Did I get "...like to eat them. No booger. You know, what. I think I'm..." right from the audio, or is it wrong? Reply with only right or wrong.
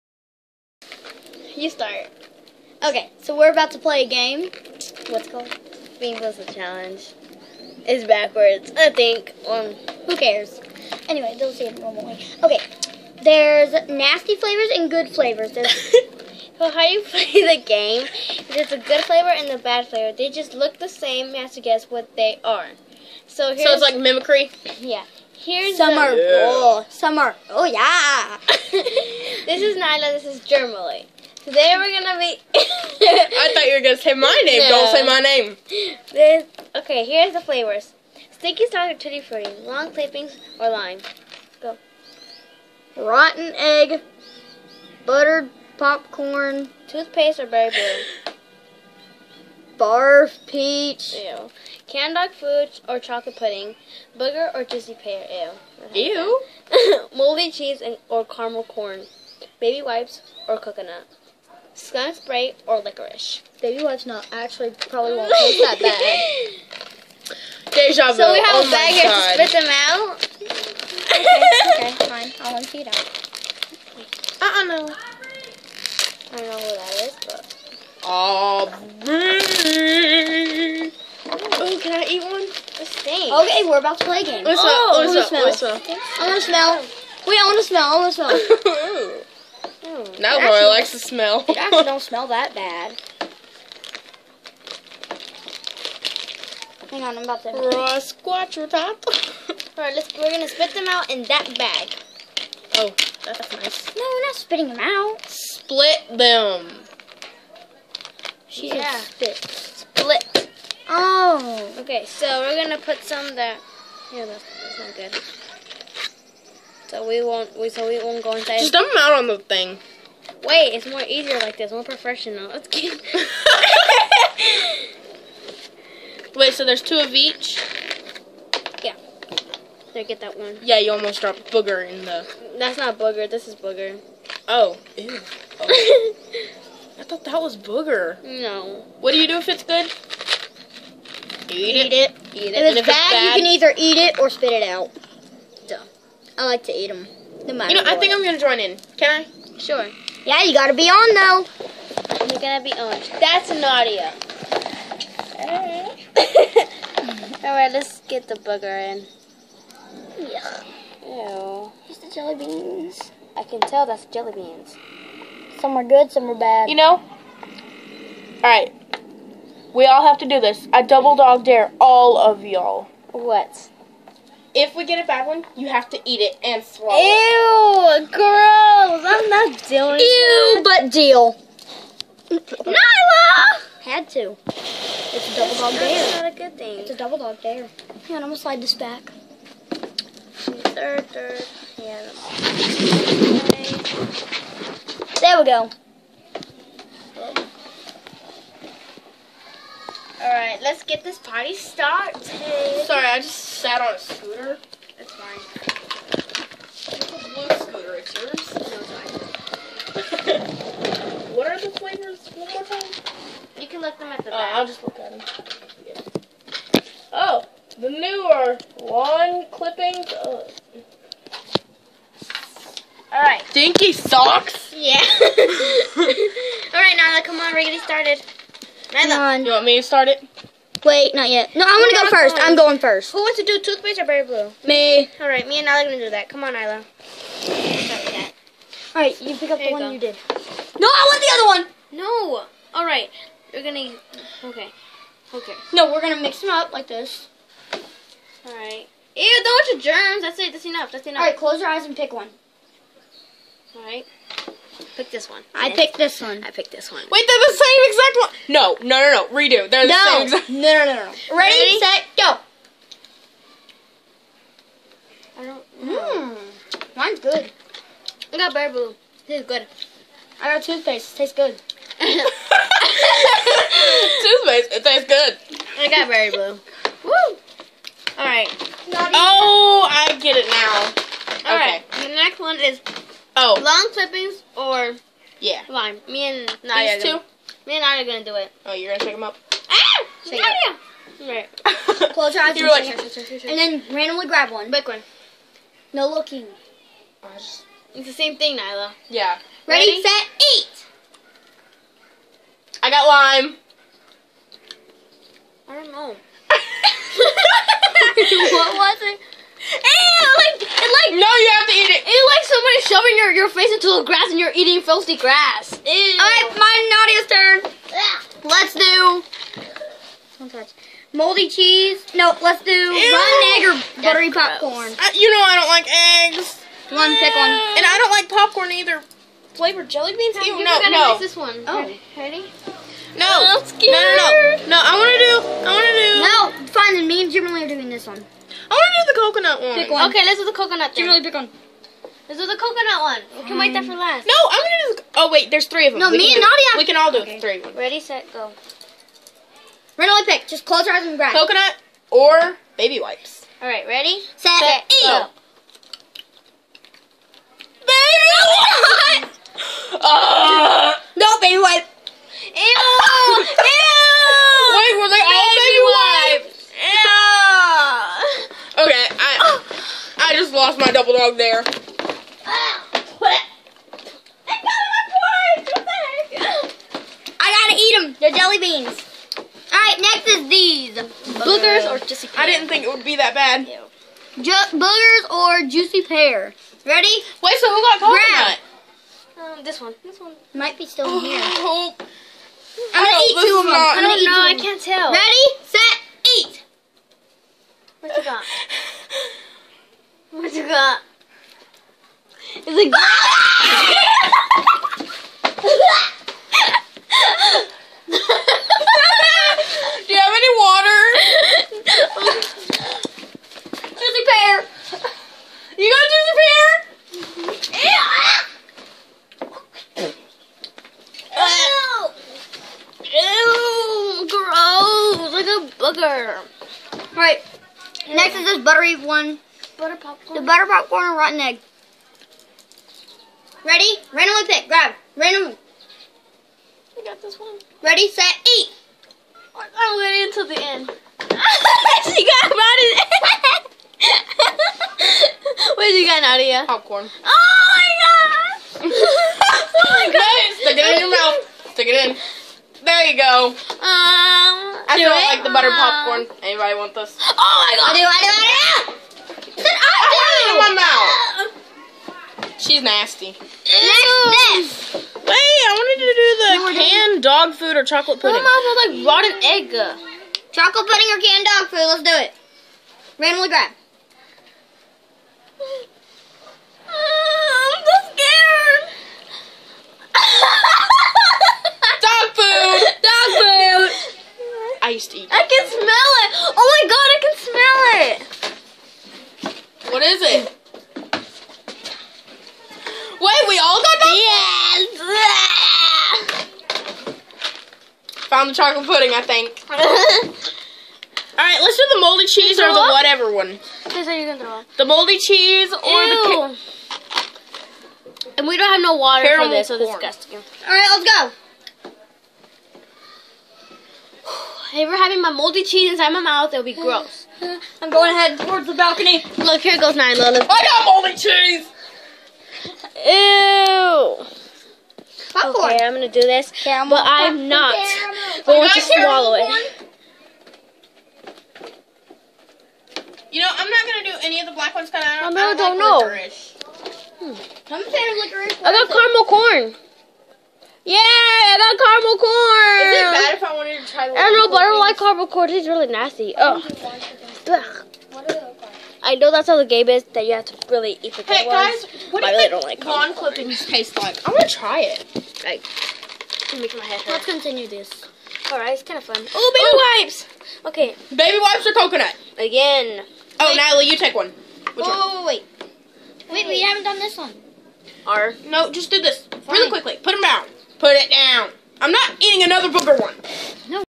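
wrong.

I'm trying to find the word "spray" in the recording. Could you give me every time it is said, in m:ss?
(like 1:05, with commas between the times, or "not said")
1:02.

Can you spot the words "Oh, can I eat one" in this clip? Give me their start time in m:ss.
1:21.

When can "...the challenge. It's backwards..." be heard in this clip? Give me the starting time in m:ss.
0:06.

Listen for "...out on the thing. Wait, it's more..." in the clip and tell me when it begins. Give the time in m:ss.
1:59.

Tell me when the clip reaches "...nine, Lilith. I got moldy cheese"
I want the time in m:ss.
8:39.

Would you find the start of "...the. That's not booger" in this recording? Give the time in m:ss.
2:12.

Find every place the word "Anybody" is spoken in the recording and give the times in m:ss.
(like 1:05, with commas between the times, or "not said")
7:36.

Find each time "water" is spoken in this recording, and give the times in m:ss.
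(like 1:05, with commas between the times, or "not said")
6:50, 8:28.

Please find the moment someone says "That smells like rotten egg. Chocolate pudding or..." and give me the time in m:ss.
7:48.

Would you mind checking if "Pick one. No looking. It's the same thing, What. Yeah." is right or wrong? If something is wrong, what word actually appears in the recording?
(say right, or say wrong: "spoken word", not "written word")
wrong: "Nyla", not "What".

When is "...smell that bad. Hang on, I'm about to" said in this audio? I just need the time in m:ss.
1:31.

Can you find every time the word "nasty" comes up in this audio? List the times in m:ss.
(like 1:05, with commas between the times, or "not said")
0:13, 7:42, 9:05.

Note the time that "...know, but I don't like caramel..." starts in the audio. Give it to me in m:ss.
9:04.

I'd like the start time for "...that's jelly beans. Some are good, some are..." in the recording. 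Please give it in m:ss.
2:43.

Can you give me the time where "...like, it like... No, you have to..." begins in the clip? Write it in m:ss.
5:10.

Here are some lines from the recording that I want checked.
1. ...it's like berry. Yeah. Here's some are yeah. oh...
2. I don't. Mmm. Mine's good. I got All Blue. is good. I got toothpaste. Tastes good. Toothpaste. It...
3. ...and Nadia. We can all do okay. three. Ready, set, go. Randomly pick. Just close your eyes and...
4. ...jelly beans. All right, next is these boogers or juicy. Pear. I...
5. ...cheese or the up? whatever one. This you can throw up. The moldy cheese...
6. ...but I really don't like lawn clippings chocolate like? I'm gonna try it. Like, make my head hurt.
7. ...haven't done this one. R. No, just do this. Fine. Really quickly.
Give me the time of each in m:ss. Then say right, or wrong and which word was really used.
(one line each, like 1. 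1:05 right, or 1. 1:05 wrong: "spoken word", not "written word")
1. 0:23 wrong: "mimicry", not "berry"
2. 4:25 wrong: "Berry", not "All"
3. 5:46 right
4. 6:18 right
5. 8:22 right
6. 9:12 wrong: "taste", not "chocolate"
7. 9:26 right.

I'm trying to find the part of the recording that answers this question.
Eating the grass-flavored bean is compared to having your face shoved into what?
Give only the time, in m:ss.
5:14.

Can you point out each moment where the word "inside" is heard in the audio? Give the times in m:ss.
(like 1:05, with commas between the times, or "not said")
1:58, 8:35.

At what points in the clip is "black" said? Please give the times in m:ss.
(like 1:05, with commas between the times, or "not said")
8:54.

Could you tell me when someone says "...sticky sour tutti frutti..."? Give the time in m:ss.
0:38.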